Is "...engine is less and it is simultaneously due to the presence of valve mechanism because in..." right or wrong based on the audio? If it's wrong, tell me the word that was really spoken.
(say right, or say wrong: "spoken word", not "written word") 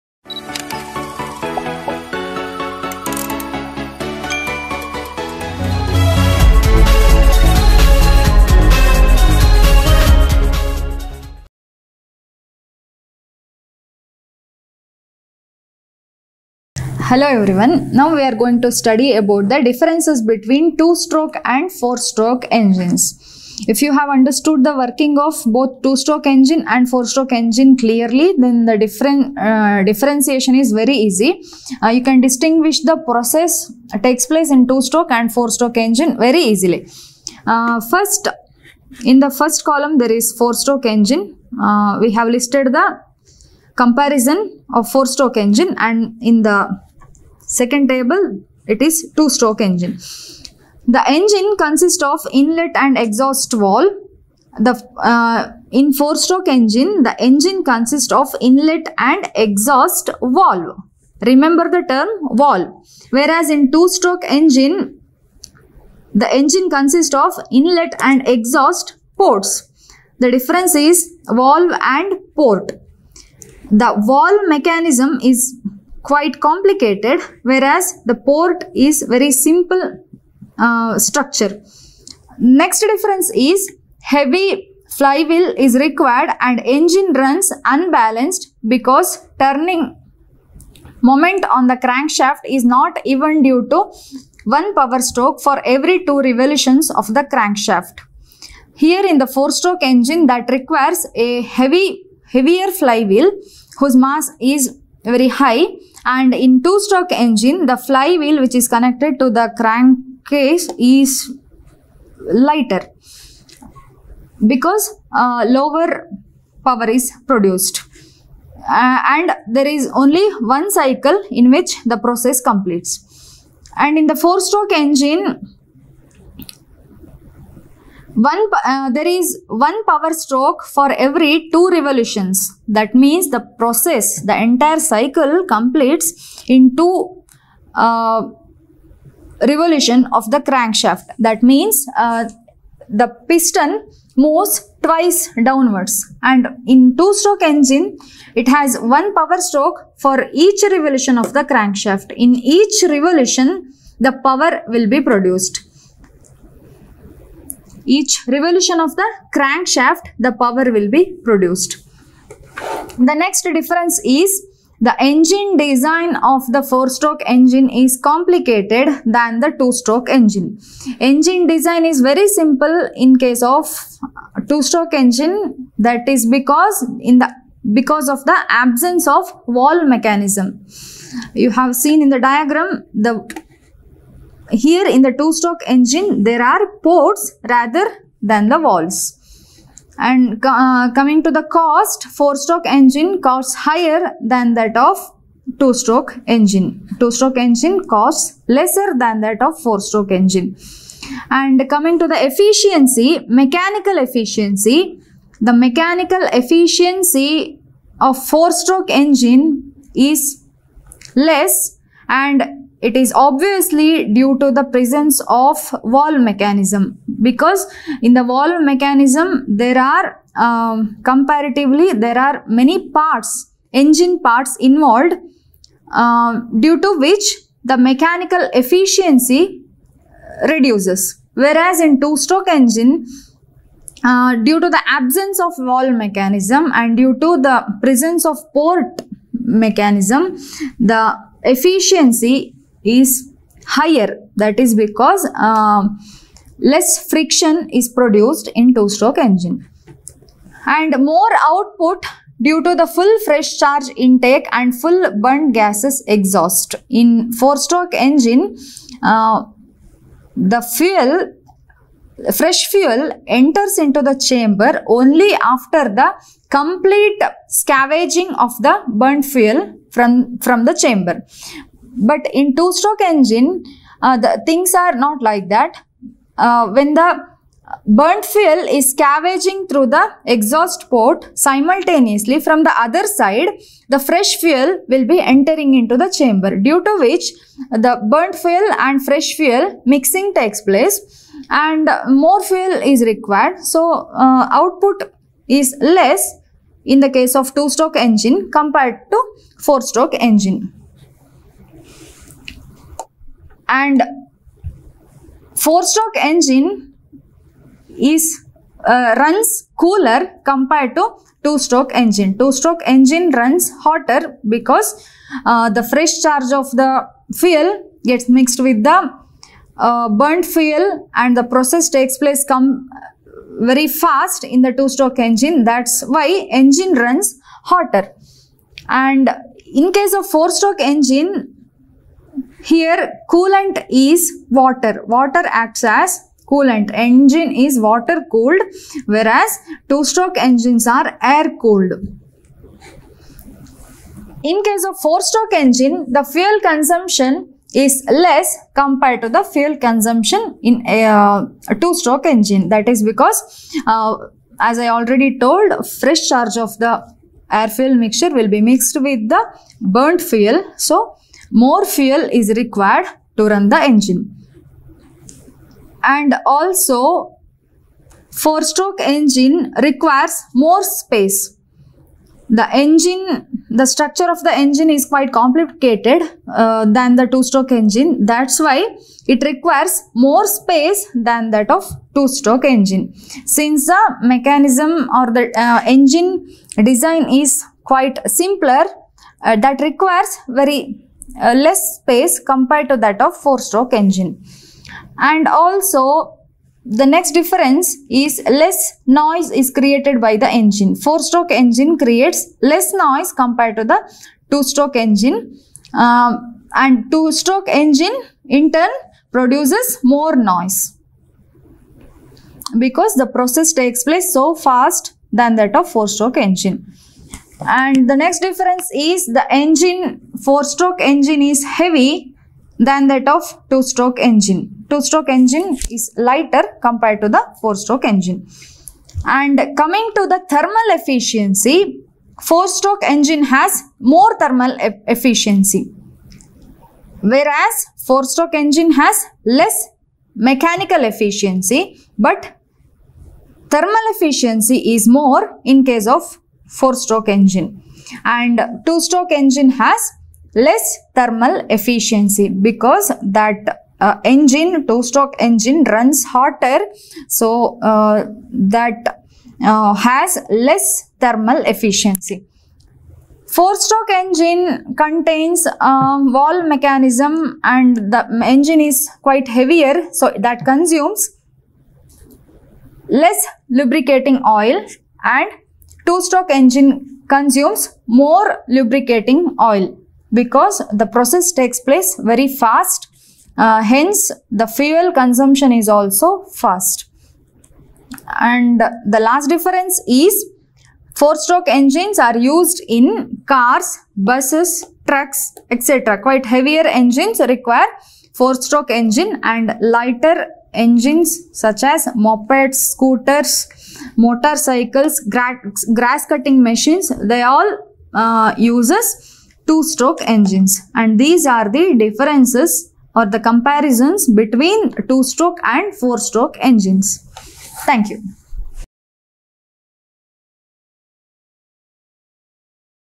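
wrong: "obviously", not "simultaneously".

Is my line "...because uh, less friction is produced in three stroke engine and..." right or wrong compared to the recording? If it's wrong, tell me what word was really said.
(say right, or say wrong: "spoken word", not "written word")
wrong: "two", not "three".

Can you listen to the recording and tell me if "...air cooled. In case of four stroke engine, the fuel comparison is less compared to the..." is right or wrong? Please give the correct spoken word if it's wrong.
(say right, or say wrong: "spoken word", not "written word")
wrong: "consumption", not "comparison".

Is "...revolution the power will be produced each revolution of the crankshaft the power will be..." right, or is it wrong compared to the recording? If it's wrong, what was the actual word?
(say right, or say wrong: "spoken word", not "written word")
right.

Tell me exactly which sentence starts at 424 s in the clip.
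Two-stroke engine is lighter compared to the four-stroke engine.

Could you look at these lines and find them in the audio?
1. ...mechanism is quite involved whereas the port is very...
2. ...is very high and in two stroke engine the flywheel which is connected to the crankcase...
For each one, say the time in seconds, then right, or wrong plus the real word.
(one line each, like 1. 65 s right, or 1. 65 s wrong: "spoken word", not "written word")
1. 74 s wrong: "complicated", not "involved"
2. 104 s right.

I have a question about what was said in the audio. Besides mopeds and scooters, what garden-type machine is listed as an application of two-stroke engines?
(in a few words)
Grass cutting machines.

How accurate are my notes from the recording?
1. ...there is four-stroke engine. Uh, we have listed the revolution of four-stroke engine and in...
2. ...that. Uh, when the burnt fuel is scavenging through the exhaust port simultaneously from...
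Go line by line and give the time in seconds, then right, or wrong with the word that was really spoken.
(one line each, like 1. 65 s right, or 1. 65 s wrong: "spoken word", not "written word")
1. 39 s wrong: "comparison", not "revolution"
2. 275 s right.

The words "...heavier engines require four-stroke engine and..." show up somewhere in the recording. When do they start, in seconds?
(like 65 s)
496 s.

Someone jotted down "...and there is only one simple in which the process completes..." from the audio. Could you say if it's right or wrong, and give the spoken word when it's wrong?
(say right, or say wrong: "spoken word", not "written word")
wrong: "cycle", not "simple".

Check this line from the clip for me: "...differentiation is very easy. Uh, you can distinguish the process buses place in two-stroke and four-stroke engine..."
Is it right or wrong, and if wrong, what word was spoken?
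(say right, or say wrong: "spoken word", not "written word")
wrong: "takes", not "buses".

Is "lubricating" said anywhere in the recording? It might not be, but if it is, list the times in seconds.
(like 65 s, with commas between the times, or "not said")
473 s, 478 s.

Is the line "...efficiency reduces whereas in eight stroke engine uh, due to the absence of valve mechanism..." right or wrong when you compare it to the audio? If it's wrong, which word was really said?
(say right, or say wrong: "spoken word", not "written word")
wrong: "two", not "eight".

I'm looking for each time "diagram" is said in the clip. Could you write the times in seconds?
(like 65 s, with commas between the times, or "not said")
182 s.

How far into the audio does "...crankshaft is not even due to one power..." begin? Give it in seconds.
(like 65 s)
91 s.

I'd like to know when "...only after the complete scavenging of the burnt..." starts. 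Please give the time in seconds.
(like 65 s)
264 s.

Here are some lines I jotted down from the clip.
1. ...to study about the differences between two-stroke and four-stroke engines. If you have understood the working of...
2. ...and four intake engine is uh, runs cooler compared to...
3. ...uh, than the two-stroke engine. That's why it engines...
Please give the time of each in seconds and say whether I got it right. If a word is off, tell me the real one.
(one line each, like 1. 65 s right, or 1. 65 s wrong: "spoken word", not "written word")
1. 18 s right
2. 303 s wrong: "stroke", not "intake"
3. 376 s wrong: "requires", not "engines".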